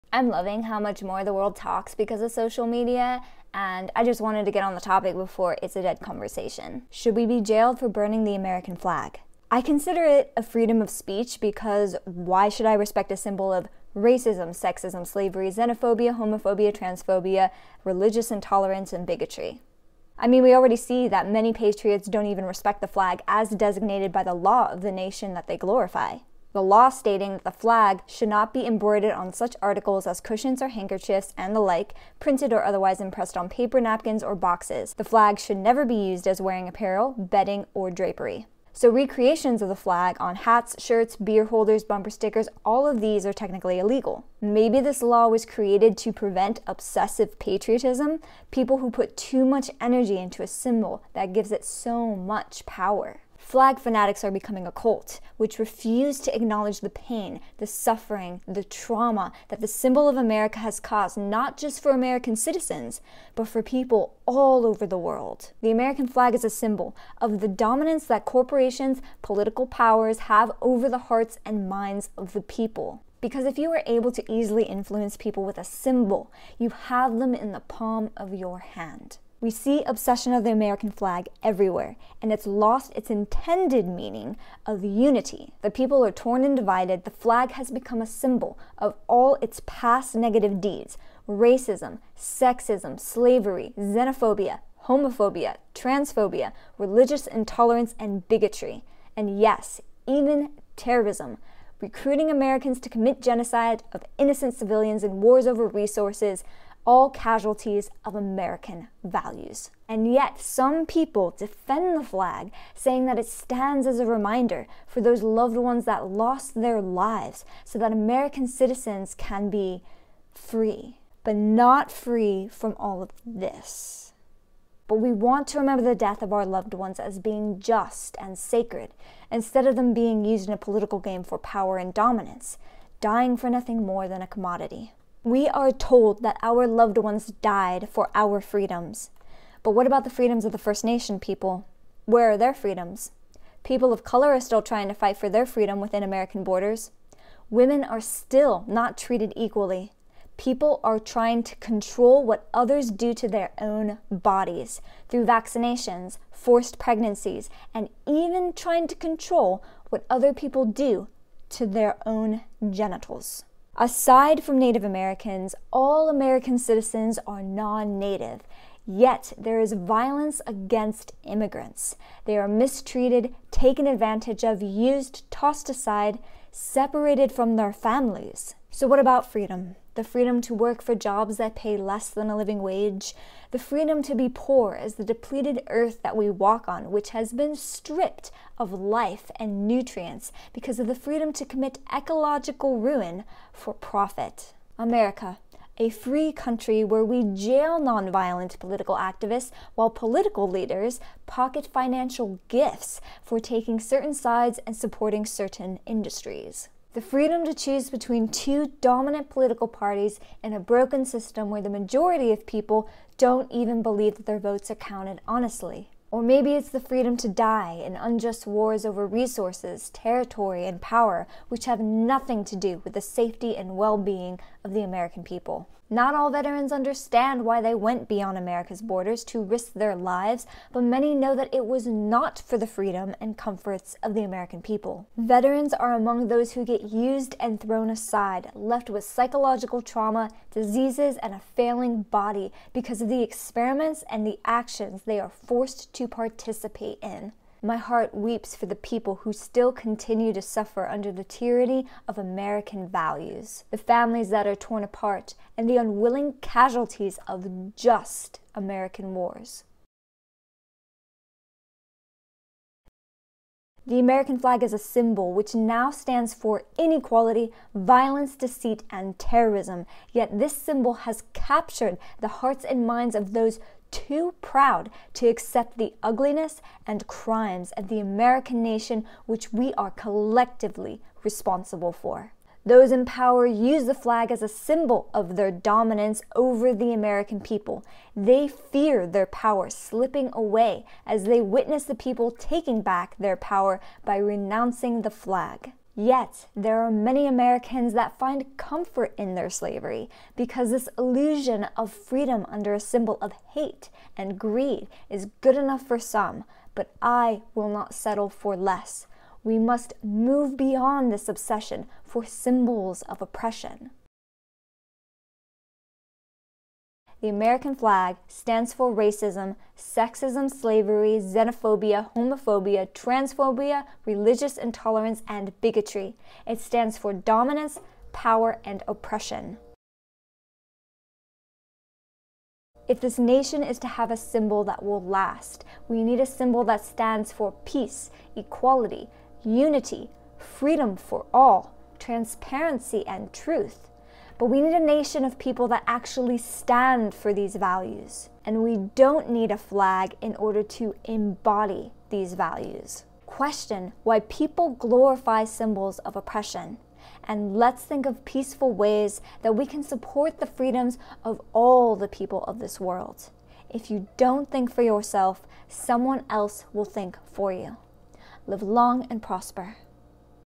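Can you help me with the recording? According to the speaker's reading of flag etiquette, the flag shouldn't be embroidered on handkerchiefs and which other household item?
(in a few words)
Cushions.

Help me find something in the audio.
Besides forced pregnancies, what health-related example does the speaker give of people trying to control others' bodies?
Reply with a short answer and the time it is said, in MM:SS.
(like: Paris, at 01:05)
Vaccinations, at 02:35.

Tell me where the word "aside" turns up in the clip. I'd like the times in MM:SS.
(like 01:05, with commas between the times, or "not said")
02:43, 02:55, 03:57.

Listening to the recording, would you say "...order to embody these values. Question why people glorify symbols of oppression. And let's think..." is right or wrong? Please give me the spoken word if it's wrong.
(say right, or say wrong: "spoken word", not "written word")
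right.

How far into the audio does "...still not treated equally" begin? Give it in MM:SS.
02:28.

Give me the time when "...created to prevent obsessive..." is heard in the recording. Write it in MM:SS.
00:45.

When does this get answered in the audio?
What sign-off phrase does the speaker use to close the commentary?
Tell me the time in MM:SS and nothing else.
06:08.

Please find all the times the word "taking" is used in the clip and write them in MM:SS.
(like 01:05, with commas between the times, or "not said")
03:23, 04:52.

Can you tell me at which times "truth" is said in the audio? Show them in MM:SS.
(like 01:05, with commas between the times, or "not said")
05:43.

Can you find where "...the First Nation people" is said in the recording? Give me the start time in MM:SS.
02:20.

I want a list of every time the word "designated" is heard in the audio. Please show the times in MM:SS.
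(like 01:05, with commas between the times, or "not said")
00:23.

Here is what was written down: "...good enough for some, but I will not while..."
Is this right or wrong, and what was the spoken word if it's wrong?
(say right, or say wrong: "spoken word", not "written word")
wrong: "settle", not "while".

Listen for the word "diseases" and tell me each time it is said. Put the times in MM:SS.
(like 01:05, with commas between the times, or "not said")
04:00.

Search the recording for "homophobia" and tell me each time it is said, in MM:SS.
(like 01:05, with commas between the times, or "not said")
00:16, 01:34, 05:22.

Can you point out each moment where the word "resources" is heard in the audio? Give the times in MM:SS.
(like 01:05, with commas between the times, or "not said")
01:45, 03:39.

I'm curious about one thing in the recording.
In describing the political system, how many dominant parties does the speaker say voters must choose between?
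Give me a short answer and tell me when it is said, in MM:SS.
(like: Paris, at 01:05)
2, at 03:28.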